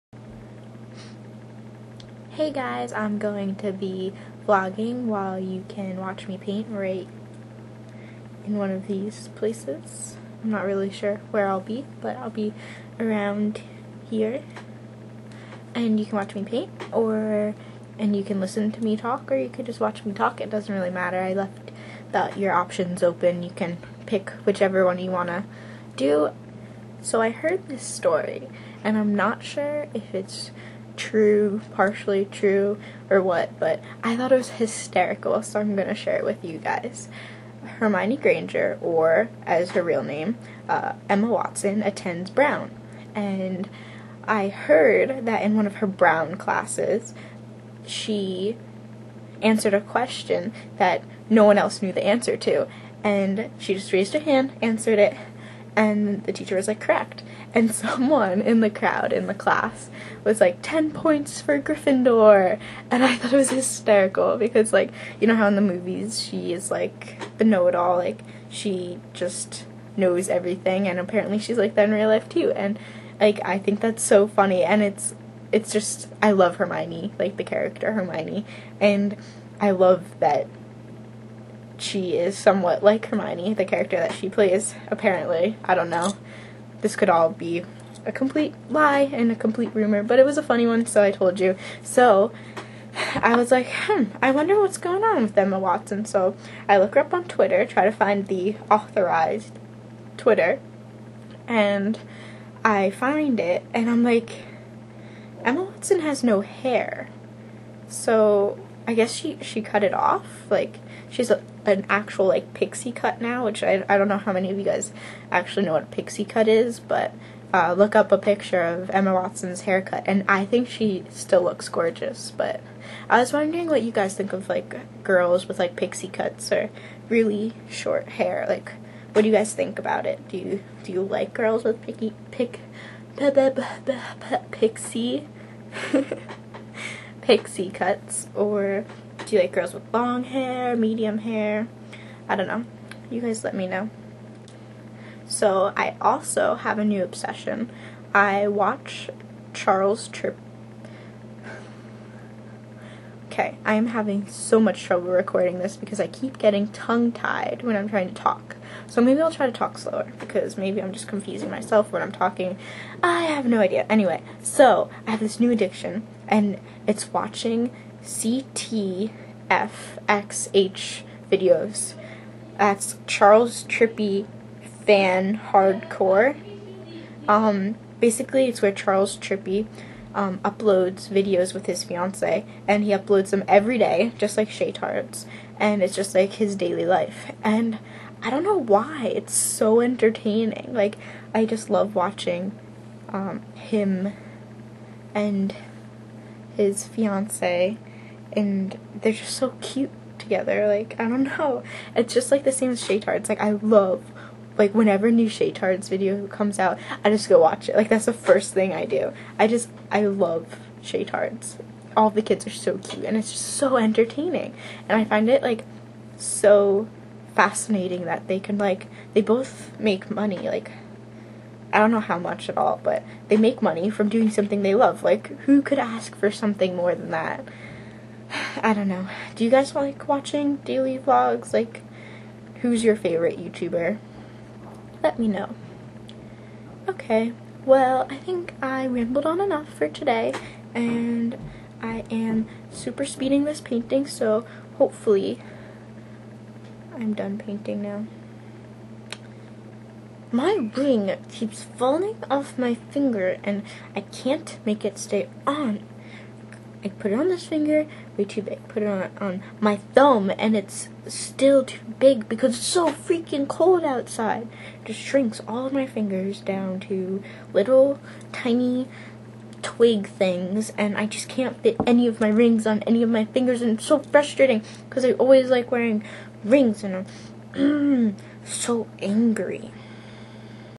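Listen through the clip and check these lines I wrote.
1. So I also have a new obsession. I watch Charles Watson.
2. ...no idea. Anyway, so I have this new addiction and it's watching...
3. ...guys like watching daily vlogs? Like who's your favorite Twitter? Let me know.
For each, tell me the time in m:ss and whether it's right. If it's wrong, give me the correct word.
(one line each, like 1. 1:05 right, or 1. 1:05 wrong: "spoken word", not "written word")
1. 2:25 wrong: "Trip", not "Watson"
2. 2:43 right
3. 3:49 wrong: "YouTuber", not "Twitter".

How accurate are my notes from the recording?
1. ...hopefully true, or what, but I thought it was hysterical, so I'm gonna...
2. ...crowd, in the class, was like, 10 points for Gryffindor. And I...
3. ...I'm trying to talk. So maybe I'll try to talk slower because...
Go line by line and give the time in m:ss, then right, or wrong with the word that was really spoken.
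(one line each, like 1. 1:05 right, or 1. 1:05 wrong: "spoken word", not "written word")
1. 0:31 wrong: "partially", not "hopefully"
2. 0:58 right
3. 2:37 right.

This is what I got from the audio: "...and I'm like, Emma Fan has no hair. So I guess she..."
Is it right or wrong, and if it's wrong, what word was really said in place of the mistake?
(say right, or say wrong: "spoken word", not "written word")
wrong: "Watson", not "Fan".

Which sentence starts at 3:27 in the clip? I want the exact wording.
Like that's the first thing I do.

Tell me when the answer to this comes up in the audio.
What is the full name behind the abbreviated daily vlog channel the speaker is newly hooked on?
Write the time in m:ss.
2:53.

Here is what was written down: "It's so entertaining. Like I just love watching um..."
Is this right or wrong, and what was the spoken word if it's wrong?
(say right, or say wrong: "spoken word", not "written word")
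right.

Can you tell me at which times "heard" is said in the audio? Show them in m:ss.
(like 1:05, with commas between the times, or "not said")
0:27, 0:44.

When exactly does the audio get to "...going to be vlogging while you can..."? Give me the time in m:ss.
0:03.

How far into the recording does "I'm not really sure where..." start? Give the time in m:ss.
0:10.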